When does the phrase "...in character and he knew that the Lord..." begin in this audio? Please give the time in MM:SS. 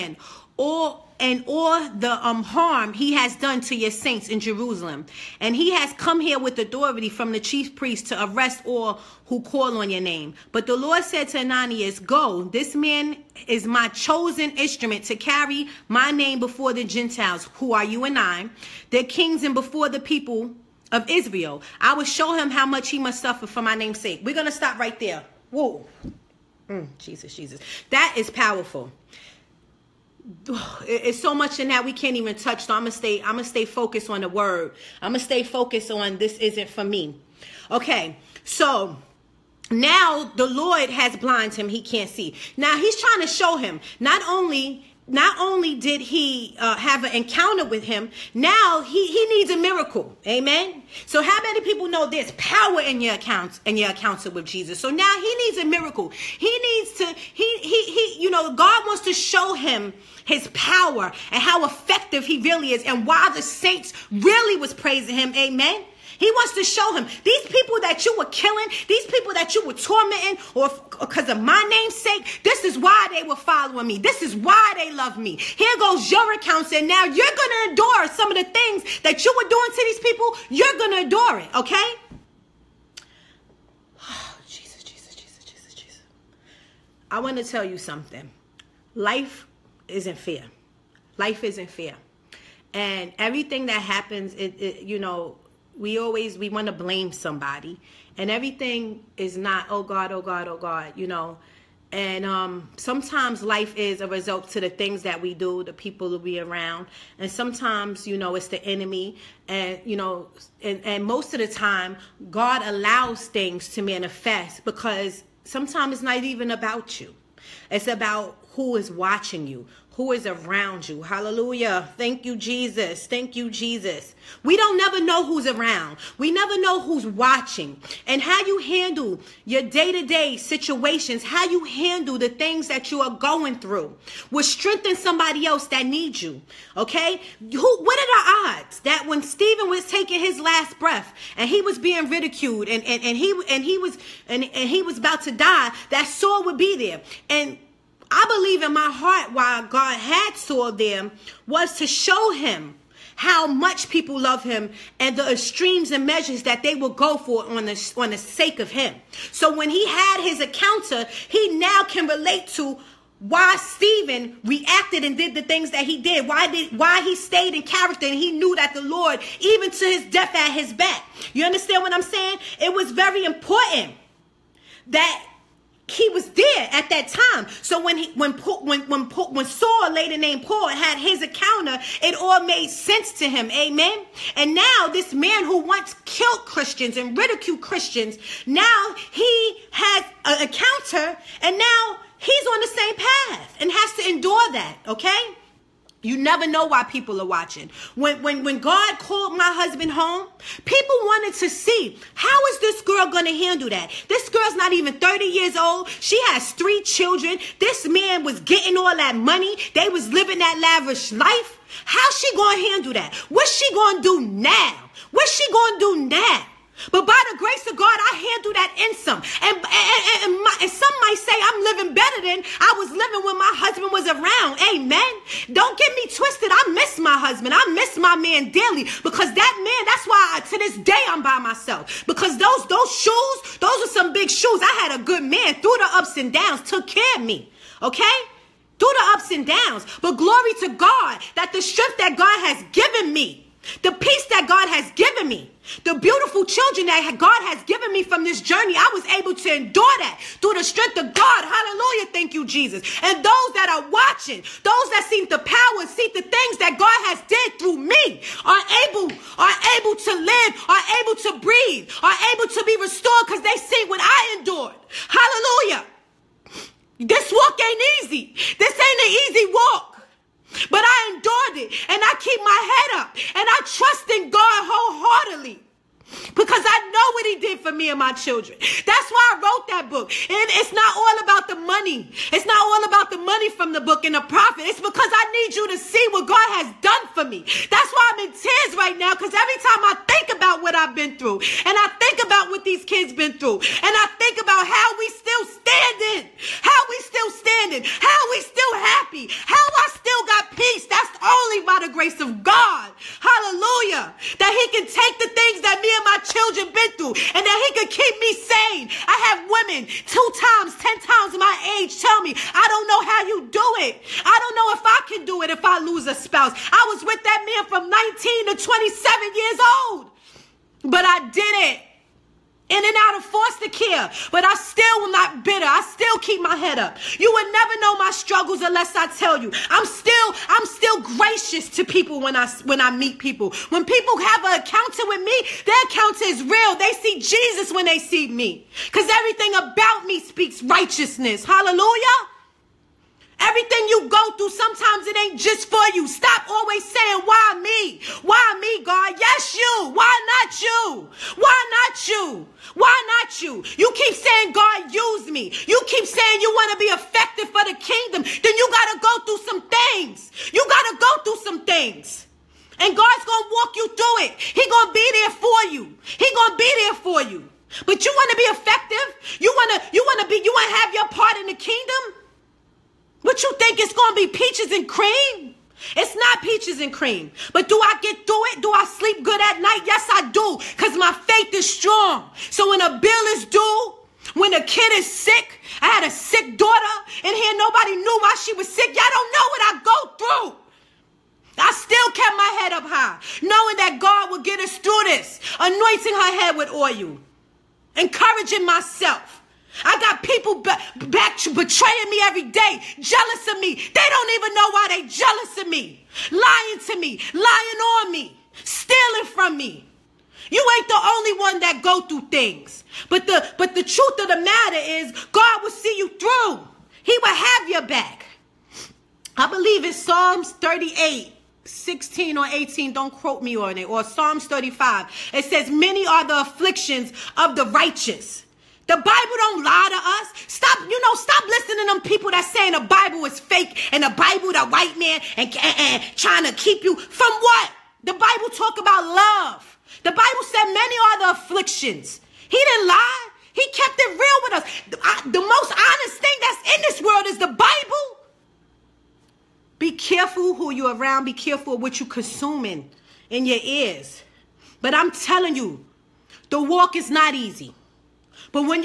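02:47.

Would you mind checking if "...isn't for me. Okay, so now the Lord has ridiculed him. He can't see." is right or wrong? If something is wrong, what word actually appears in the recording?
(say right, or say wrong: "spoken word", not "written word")
wrong: "blinded", not "ridiculed".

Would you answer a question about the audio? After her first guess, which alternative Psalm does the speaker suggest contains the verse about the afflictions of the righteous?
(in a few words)
Psalms 35.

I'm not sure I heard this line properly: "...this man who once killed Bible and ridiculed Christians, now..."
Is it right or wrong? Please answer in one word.
wrong.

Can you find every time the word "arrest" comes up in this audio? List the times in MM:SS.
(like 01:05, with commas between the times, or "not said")
00:08.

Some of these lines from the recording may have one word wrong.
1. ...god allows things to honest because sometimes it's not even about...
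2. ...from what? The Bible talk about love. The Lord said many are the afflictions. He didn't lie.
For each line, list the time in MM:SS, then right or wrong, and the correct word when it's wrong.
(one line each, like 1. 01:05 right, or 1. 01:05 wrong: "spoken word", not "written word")
1. 01:52 wrong: "manifest", not "honest"
2. 07:16 wrong: "Bible", not "Lord".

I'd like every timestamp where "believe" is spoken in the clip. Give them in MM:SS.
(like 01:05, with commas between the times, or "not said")
02:28, 06:59.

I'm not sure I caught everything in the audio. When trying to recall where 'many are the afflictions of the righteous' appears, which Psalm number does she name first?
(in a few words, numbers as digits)
Psalms 38.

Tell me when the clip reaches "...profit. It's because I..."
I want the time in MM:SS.
04:44.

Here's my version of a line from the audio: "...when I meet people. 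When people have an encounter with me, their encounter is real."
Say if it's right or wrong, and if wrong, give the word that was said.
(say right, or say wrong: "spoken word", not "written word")
right.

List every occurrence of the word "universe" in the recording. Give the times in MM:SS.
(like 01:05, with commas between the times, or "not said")
not said.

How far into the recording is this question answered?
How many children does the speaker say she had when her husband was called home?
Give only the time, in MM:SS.
03:26.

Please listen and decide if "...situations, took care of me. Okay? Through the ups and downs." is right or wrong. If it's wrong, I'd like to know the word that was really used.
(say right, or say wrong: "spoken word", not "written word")
wrong: "downs", not "situations".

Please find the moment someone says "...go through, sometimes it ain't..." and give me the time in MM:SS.
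05:44.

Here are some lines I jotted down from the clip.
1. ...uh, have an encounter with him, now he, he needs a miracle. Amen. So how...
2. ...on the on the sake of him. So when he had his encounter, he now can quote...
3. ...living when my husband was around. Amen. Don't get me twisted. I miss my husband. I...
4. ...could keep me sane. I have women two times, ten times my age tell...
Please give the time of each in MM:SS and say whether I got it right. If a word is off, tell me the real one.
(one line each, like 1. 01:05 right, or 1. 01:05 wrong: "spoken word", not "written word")
1. 00:46 right
2. 02:37 wrong: "relate", not "quote"
3. 03:42 right
4. 05:07 right.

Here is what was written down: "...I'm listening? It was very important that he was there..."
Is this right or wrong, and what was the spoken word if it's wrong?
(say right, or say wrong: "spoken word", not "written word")
wrong: "saying", not "listening".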